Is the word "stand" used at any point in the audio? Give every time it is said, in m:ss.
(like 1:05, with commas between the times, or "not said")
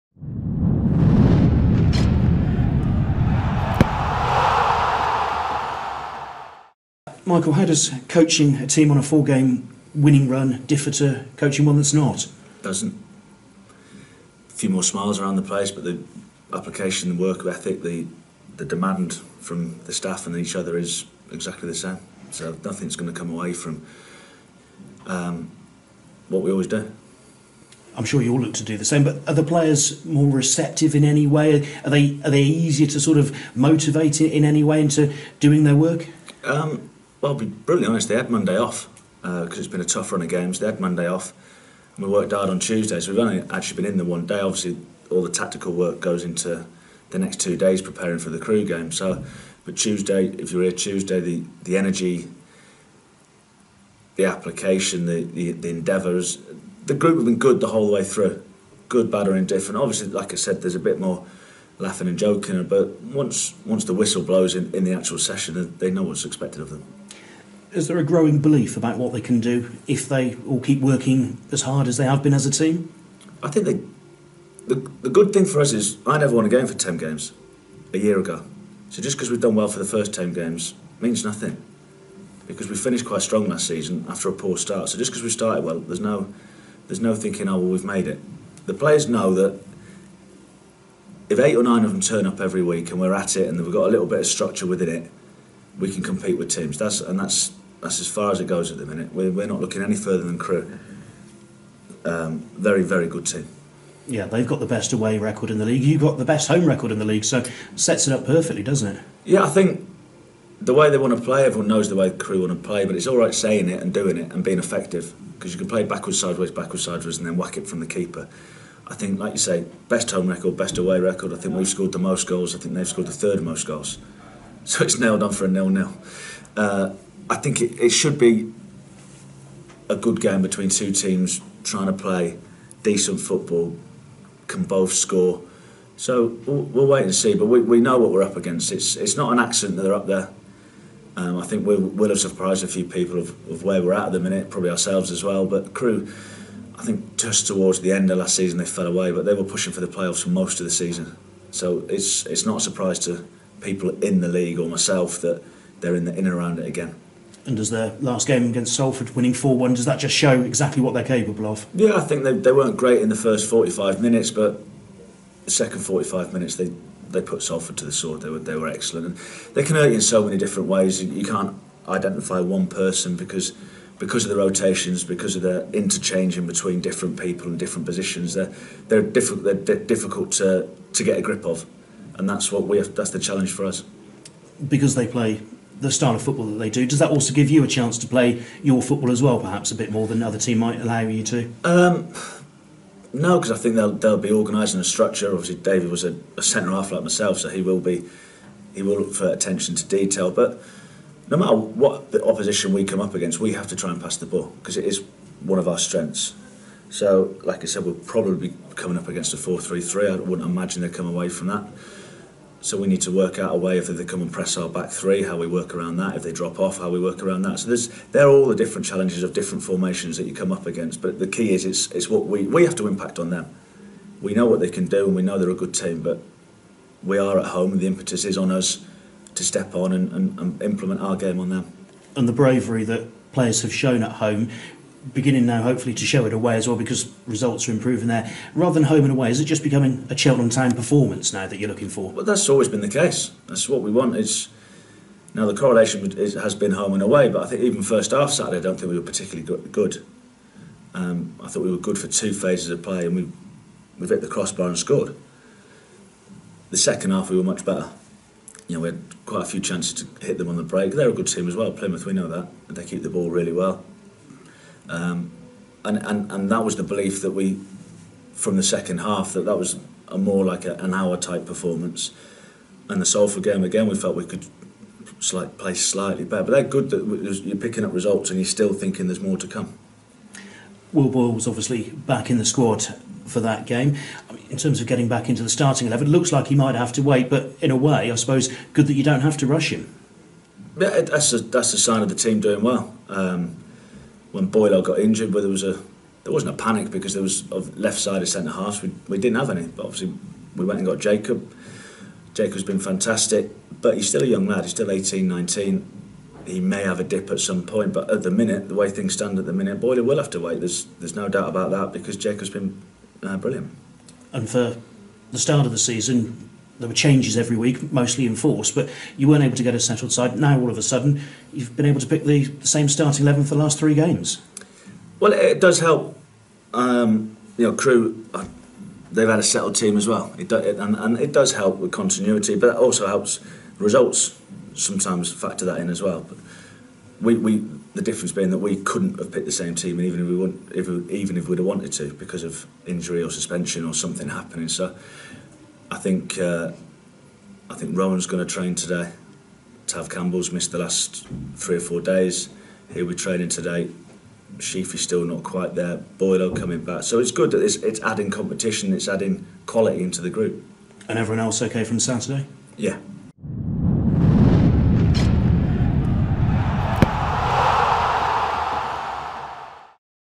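5:09.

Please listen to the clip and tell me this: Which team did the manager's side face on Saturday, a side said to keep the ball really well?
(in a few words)
Plymouth.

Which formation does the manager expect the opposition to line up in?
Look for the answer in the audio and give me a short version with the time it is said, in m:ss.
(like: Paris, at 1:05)
4-3-3, at 3:29.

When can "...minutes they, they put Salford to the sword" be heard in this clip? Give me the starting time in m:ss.
2:46.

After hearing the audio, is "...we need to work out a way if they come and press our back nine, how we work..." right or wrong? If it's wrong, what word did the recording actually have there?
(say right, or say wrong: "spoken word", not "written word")
wrong: "three", not "nine".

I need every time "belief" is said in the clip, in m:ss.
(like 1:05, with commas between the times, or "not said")
1:08, 4:26.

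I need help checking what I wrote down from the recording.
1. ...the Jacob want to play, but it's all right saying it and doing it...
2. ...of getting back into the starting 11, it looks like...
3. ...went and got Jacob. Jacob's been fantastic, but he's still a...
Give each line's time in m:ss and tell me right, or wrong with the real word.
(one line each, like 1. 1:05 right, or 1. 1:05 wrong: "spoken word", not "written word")
1. 1:52 wrong: "Crewe", not "Jacob"
2. 4:44 right
3. 5:00 right.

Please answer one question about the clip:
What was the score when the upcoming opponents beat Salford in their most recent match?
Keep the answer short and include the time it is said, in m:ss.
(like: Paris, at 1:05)
4-1, at 2:39.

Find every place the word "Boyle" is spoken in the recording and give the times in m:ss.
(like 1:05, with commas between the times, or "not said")
4:41, 4:54, 5:09, 5:56.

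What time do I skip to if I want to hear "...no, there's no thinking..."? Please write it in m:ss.
1:26.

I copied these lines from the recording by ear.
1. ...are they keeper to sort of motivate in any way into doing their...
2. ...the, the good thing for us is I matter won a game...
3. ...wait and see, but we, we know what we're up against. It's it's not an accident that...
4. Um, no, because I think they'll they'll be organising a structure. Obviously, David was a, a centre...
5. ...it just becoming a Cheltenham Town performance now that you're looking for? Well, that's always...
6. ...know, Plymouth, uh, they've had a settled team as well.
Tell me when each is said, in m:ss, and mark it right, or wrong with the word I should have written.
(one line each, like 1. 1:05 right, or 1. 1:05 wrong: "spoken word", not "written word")
1. 0:32 wrong: "easier", not "keeper"
2. 1:14 wrong: "never", not "matter"
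3. 2:16 right
4. 3:11 right
5. 3:59 right
6. 5:27 wrong: "Crewe", not "Plymouth".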